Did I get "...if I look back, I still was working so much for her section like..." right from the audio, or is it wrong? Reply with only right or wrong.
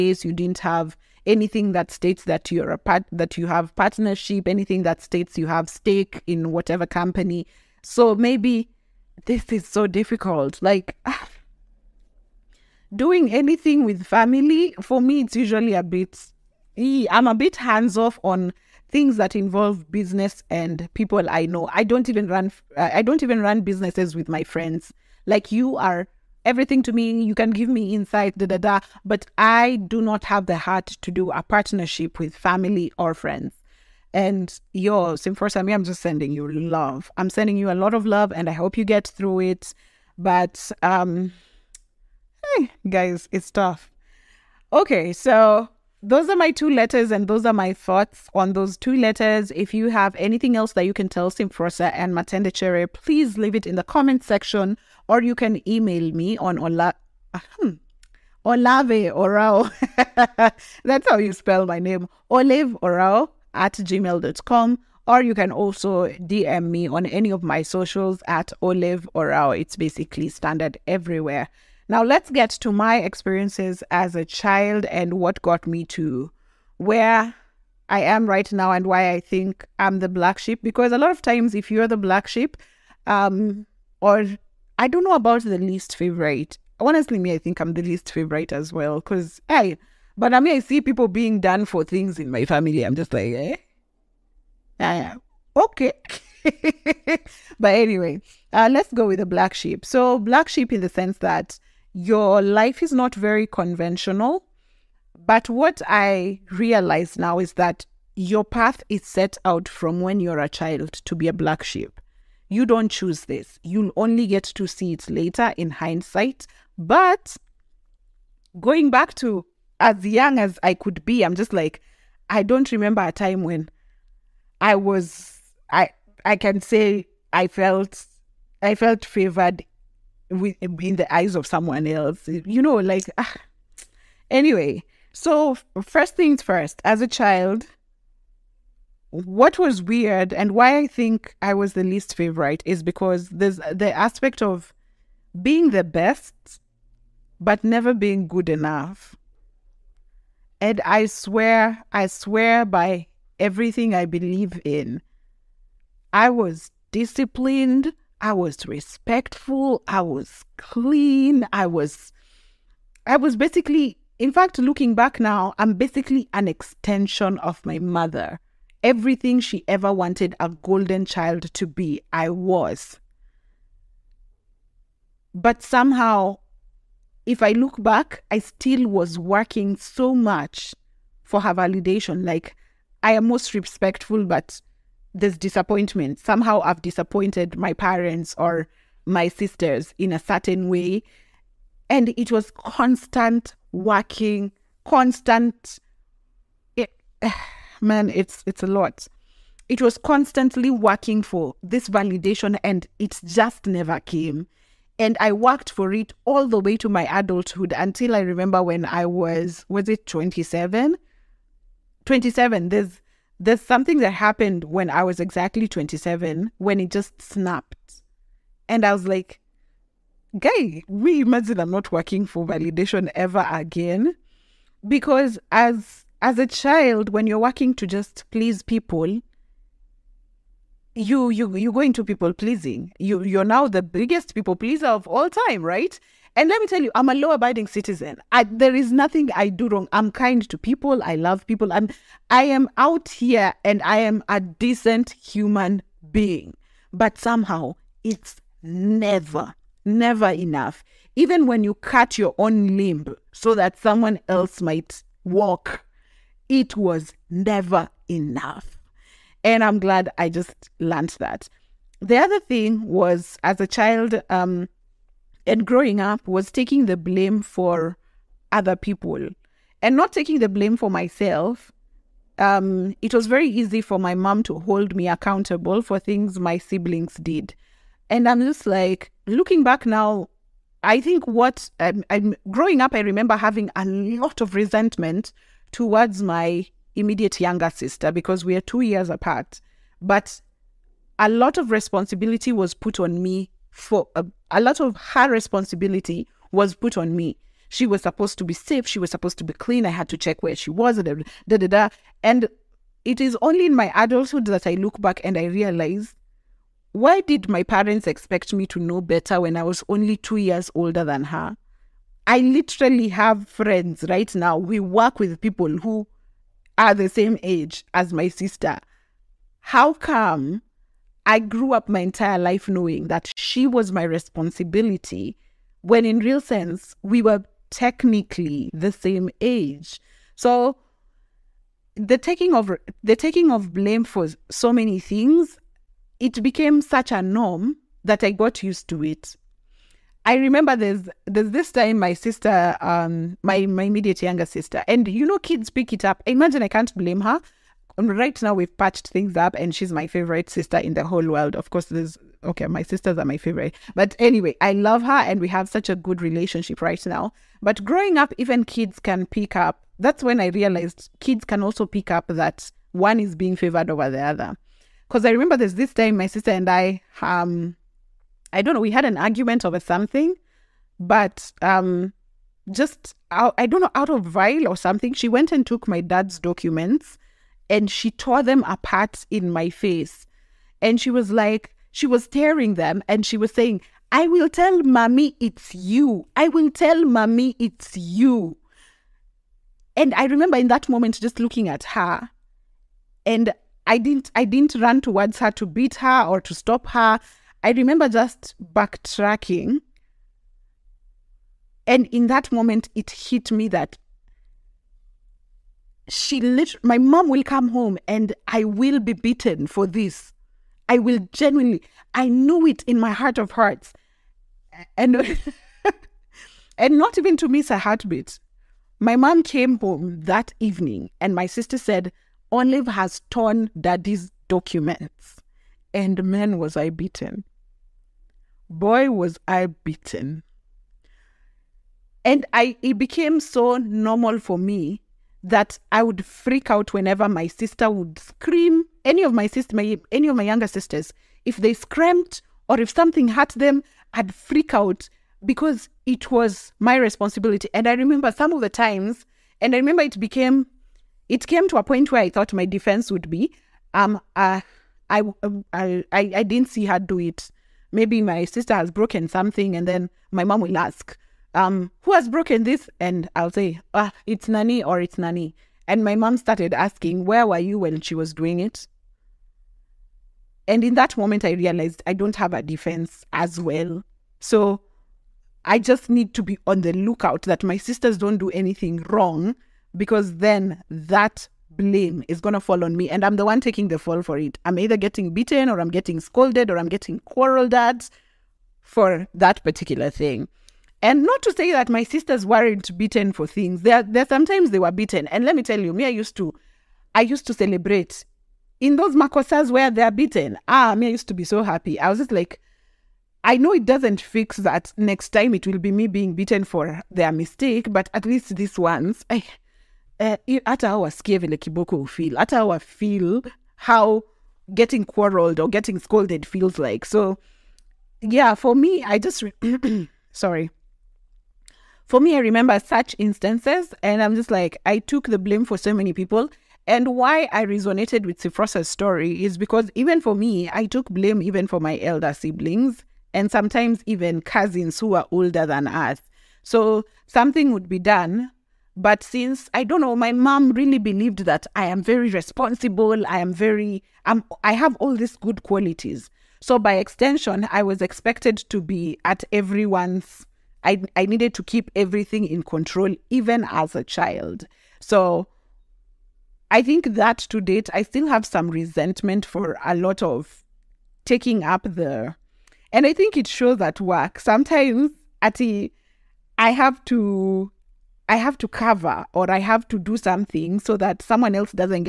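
wrong.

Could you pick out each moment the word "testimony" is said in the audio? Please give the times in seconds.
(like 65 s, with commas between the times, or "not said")
not said.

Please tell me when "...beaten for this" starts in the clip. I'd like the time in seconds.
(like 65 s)
409 s.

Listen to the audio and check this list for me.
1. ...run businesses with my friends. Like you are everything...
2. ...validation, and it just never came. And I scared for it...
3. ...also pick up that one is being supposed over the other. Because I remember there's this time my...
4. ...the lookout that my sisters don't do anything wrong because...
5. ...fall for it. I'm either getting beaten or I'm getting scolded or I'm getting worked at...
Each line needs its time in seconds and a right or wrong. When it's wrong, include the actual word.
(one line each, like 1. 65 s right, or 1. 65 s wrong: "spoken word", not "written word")
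1. 23 s right
2. 201 s wrong: "worked", not "scared"
3. 361 s wrong: "favored", not "supposed"
4. 476 s right
5. 483 s wrong: "quarreled", not "worked".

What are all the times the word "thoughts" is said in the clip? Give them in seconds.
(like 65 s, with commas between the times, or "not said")
47 s, 452 s.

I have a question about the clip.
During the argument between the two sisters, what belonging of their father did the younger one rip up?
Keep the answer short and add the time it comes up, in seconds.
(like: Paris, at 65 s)
Dad's documents, at 375 s.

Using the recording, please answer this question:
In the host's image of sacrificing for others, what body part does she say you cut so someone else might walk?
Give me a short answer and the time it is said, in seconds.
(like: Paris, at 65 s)
Limb, at 252 s.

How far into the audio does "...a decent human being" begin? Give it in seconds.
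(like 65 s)
244 s.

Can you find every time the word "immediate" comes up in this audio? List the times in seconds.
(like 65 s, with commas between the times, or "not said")
286 s, 343 s.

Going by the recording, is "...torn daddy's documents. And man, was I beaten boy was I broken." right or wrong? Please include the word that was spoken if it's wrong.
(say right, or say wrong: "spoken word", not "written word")
wrong: "beaten", not "broken".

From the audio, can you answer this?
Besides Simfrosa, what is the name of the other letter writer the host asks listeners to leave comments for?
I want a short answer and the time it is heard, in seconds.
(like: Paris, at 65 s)
Matende Chere, at 52 s.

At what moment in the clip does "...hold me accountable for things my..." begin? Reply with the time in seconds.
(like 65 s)
274 s.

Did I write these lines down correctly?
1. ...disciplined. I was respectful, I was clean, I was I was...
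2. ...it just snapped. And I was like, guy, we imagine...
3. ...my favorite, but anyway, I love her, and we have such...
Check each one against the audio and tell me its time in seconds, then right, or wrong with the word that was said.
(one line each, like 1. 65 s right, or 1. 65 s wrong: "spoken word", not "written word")
1. 156 s right
2. 216 s right
3. 353 s right.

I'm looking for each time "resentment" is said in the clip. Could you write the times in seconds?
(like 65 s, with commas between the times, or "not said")
284 s, 558 s.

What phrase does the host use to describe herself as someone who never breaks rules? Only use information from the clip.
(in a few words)
Law-abiding citizen.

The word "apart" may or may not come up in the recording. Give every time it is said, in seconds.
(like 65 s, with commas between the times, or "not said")
289 s, 378 s.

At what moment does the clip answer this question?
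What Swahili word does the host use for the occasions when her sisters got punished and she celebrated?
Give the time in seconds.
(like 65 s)
499 s.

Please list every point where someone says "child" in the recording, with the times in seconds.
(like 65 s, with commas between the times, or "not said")
74 s, 110 s, 137 s, 171 s, 226 s, 263 s, 554 s.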